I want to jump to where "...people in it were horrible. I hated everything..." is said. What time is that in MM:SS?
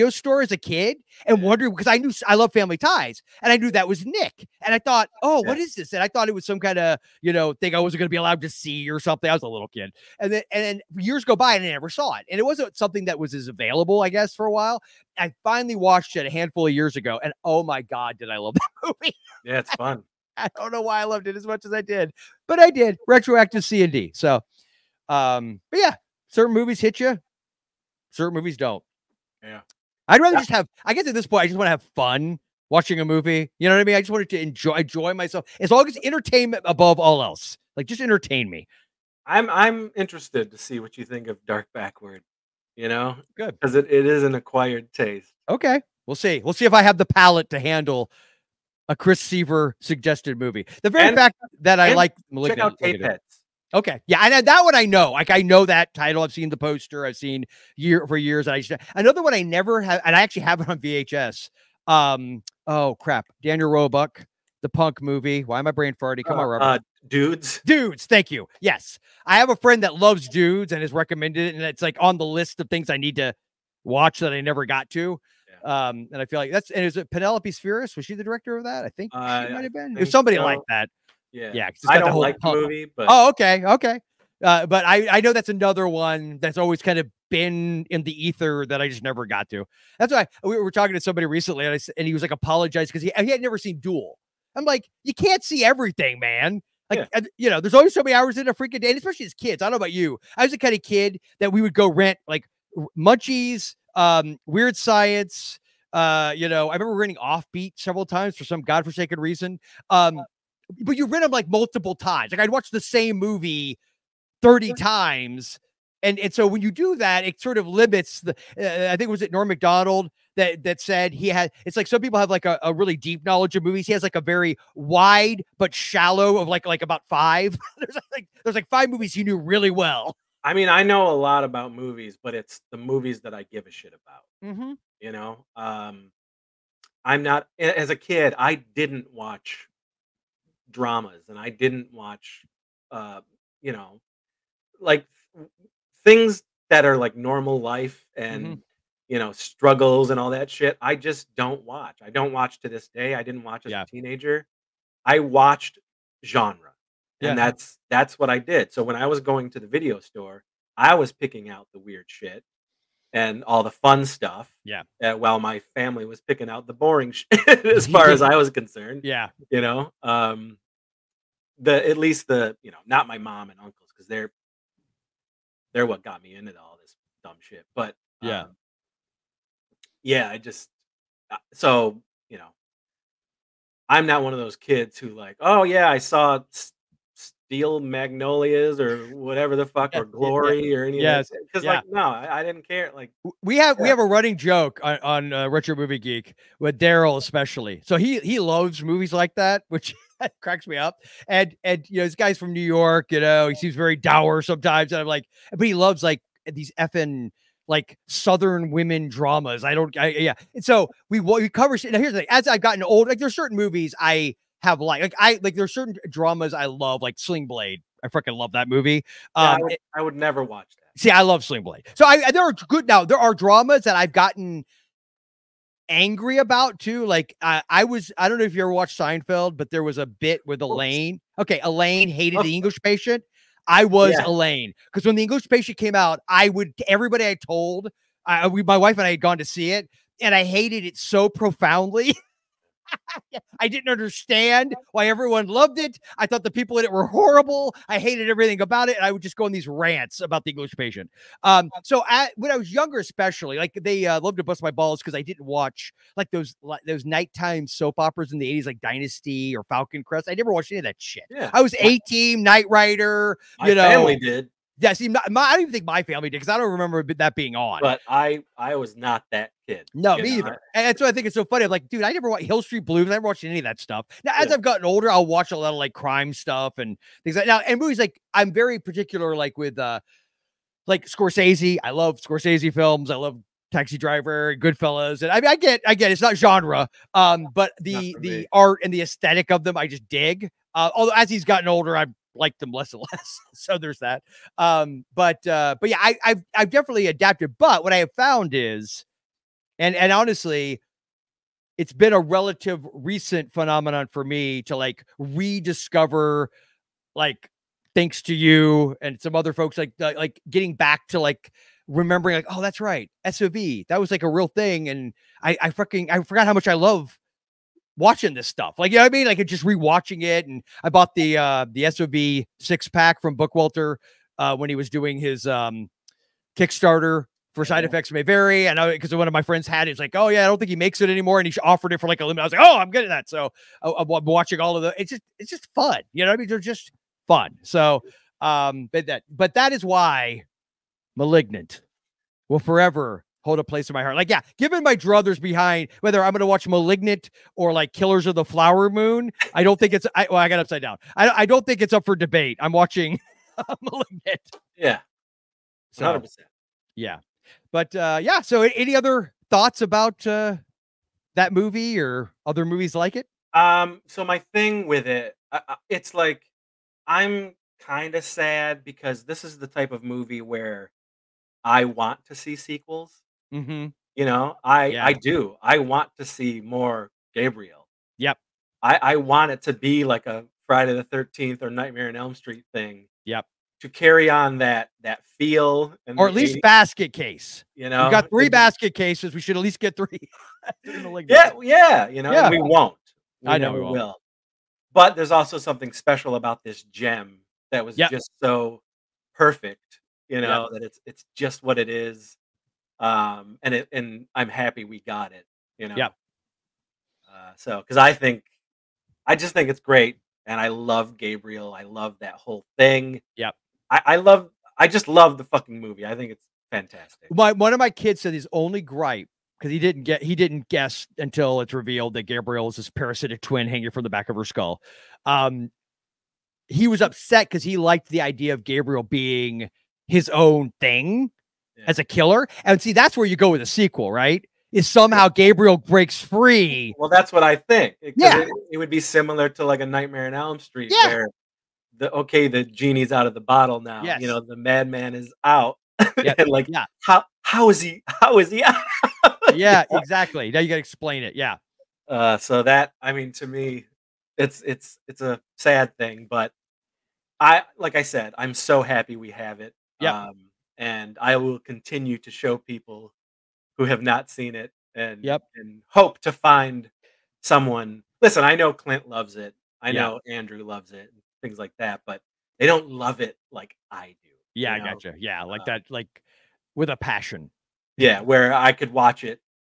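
04:06.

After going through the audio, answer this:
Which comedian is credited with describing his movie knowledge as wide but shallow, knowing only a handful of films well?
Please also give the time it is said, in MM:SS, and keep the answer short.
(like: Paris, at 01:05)
Norm Macdonald, at 01:59.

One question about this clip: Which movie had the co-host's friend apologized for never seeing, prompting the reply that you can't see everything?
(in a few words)
Duel.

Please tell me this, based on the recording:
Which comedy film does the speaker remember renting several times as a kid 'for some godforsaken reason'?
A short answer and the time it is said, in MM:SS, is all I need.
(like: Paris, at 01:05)
Offbeat, at 01:47.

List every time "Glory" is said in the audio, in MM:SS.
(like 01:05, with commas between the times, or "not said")
03:10.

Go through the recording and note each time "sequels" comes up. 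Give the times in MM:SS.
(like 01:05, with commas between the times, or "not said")
06:12, 07:13.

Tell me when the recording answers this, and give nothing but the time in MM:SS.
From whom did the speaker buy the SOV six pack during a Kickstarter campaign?
05:23.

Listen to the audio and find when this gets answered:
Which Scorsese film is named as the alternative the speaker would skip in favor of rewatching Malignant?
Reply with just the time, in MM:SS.
05:47.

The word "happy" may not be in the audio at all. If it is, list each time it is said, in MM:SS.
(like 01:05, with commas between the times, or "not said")
06:44, 07:38.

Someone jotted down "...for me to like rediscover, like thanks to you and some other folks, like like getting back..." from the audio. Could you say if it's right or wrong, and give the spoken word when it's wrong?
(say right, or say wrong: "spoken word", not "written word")
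right.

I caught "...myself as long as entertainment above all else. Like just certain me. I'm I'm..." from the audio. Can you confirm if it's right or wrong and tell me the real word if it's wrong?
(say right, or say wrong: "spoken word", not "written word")
wrong: "entertain", not "certain".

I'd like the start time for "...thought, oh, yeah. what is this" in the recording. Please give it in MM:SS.
00:04.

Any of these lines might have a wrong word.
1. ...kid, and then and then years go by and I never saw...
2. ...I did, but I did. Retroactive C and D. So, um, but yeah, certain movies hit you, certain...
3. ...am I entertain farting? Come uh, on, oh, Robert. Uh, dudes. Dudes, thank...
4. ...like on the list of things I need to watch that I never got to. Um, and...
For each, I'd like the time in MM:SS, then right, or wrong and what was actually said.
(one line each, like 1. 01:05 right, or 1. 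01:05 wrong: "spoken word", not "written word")
1. 00:09 right
2. 00:21 right
3. 01:05 wrong: "brain", not "entertain"
4. 01:11 right.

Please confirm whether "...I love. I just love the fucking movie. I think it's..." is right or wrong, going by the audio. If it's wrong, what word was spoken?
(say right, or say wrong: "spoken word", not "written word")
right.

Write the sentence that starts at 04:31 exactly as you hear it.
I'm like, dude, I never watched Hill Street Blues.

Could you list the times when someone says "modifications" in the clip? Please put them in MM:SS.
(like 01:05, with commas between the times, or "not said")
not said.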